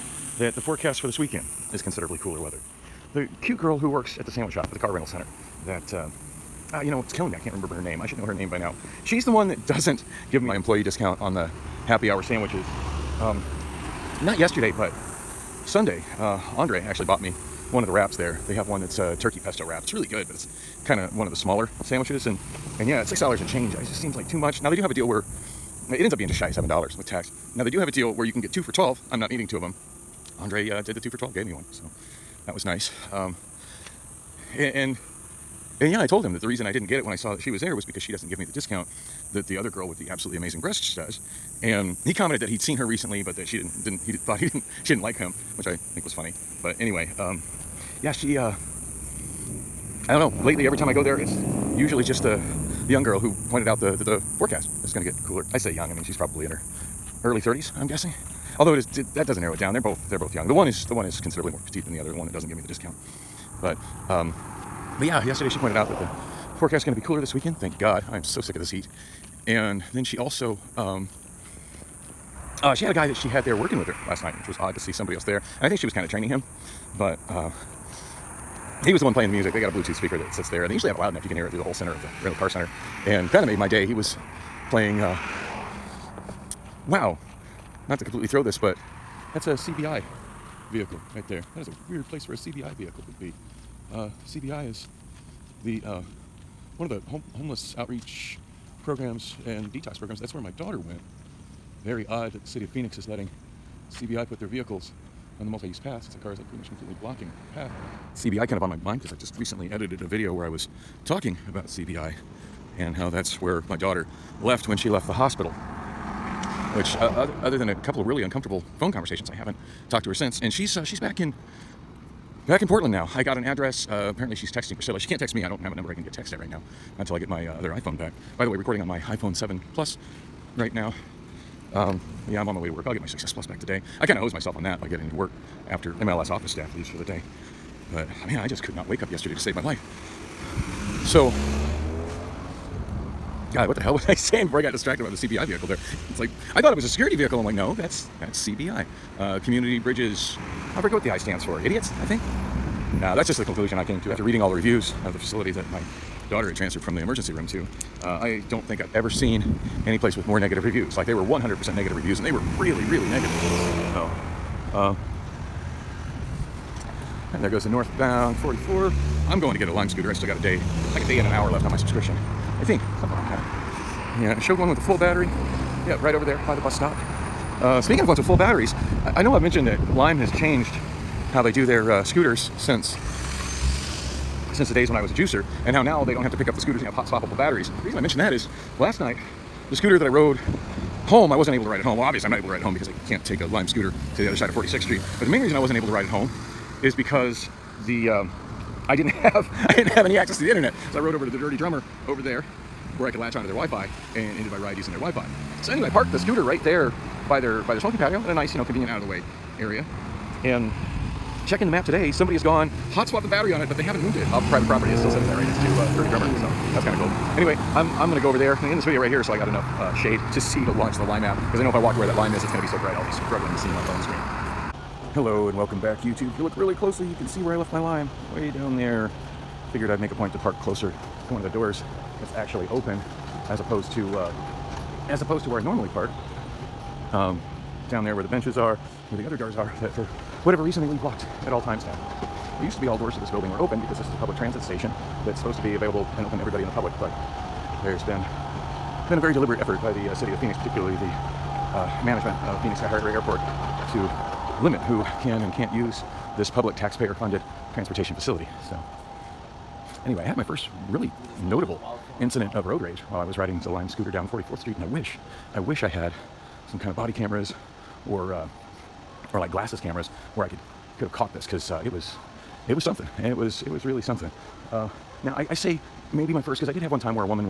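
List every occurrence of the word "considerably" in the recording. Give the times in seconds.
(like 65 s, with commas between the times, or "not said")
1 s, 61 s.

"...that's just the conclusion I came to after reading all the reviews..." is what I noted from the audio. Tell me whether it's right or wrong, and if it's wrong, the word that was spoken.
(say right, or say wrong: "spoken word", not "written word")
right.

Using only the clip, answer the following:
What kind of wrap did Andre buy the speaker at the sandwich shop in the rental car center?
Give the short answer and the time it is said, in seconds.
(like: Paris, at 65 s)
Turkey pesto wrap, at 19 s.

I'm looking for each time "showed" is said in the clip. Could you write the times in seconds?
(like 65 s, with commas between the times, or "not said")
174 s.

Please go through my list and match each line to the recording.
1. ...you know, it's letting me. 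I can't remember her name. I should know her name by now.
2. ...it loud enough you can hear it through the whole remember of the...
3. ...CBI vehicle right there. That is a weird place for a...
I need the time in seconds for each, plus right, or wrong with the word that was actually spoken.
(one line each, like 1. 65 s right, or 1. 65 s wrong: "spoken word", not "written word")
1. 6 s wrong: "killing", not "letting"
2. 80 s wrong: "center", not "remember"
3. 89 s right.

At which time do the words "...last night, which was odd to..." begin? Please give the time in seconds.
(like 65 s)
74 s.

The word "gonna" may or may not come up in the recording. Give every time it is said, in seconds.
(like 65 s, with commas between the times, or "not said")
218 s, 222 s.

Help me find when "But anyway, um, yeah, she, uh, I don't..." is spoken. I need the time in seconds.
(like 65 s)
46 s.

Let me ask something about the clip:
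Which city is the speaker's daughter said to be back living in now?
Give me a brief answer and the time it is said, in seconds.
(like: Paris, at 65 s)
Portland, at 122 s.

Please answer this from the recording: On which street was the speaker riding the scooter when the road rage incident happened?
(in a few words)
44th Street.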